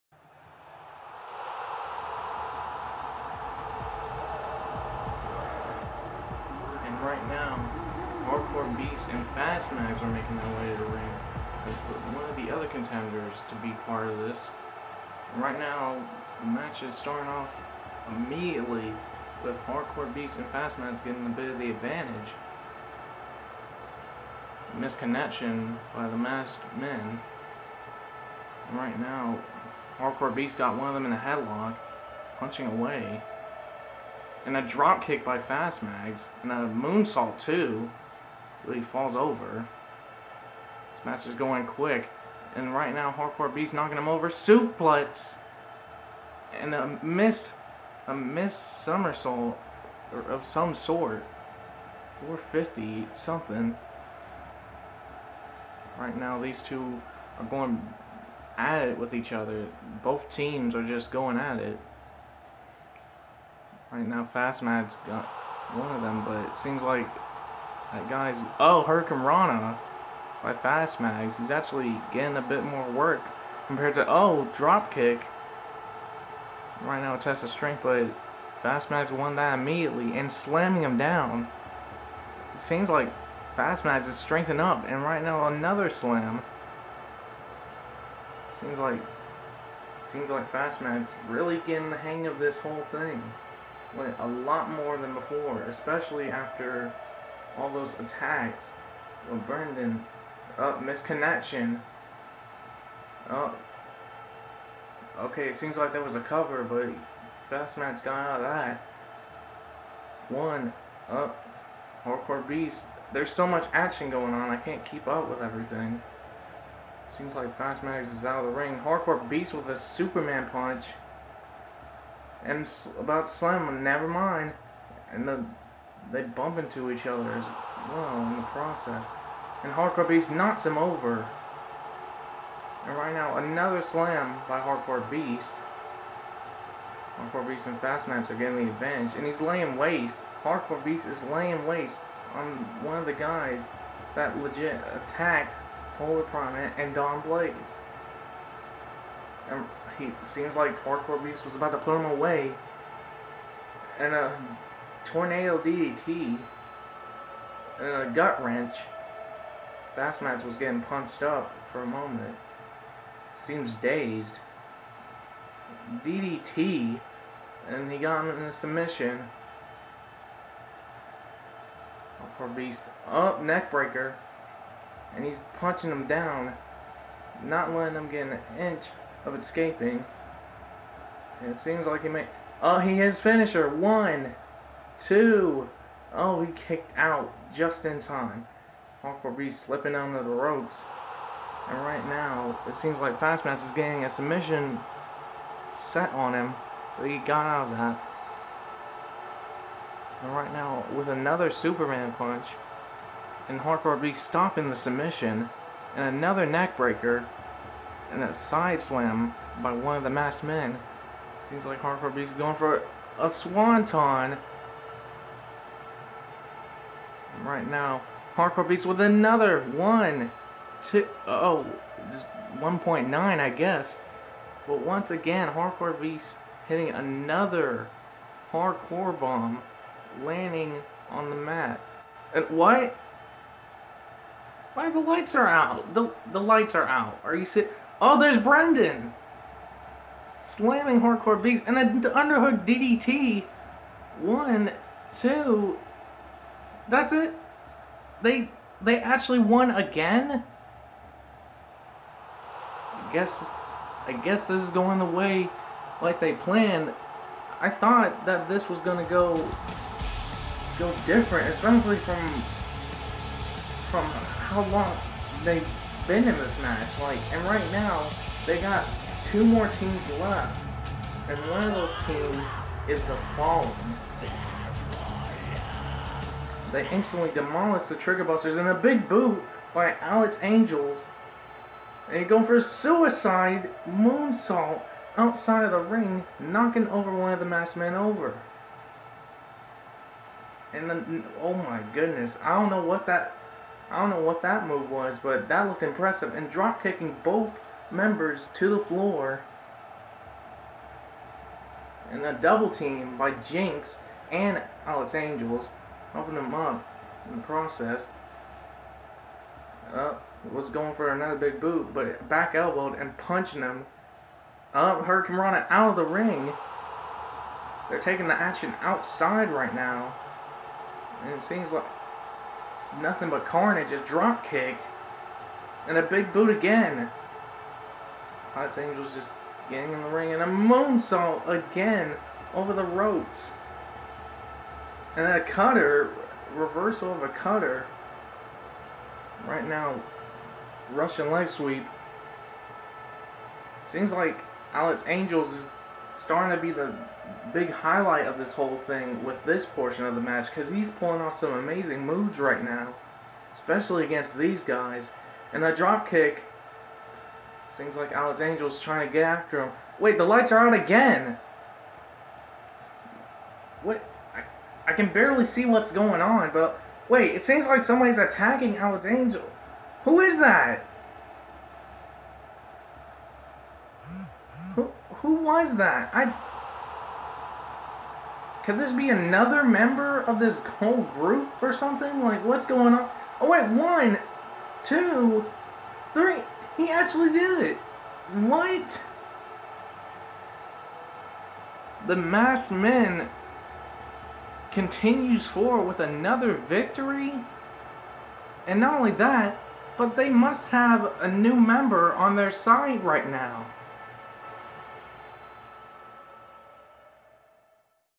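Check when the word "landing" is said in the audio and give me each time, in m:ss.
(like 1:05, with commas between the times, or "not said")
3:50.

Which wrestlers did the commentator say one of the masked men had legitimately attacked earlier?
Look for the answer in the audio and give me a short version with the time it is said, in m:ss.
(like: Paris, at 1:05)
Polar Prime, at 2:25.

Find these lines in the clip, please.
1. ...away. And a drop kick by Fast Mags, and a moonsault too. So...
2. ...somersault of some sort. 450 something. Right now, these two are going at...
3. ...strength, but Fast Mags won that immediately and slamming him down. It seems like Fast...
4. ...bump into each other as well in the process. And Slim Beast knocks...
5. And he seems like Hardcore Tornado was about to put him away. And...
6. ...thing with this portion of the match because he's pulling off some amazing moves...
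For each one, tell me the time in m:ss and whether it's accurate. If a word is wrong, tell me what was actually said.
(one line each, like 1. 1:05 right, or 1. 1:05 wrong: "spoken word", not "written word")
1. 0:32 right
2. 0:48 right
3. 1:17 right
4. 2:06 wrong: "Hardcore", not "Slim"
5. 2:29 wrong: "Beast", not "Tornado"
6. 5:48 right.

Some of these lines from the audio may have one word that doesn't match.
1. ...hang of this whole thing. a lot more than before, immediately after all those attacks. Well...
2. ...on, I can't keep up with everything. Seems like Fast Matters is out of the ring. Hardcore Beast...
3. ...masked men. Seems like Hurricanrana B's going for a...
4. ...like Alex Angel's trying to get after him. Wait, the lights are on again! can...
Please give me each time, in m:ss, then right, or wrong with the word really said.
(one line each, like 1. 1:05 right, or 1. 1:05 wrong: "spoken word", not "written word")
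1. 1:31 wrong: "especially", not "immediately"
2. 1:54 right
3. 3:30 wrong: "Hardcore", not "Hurricanrana"
4. 5:57 right.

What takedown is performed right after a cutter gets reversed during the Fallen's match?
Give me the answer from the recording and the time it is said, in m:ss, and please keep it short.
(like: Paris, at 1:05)
Russian leg sweep, at 5:40.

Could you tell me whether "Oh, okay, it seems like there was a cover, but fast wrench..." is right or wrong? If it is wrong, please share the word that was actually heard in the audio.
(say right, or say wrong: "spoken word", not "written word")
wrong: "match", not "wrench".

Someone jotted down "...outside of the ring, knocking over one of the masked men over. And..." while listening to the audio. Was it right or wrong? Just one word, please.
right.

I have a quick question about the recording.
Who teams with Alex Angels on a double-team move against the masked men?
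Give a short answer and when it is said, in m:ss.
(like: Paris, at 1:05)
Jinx, at 5:03.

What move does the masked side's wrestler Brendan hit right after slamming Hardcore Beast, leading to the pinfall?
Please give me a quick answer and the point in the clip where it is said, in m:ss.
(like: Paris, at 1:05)
Underhook DDT, at 4:02.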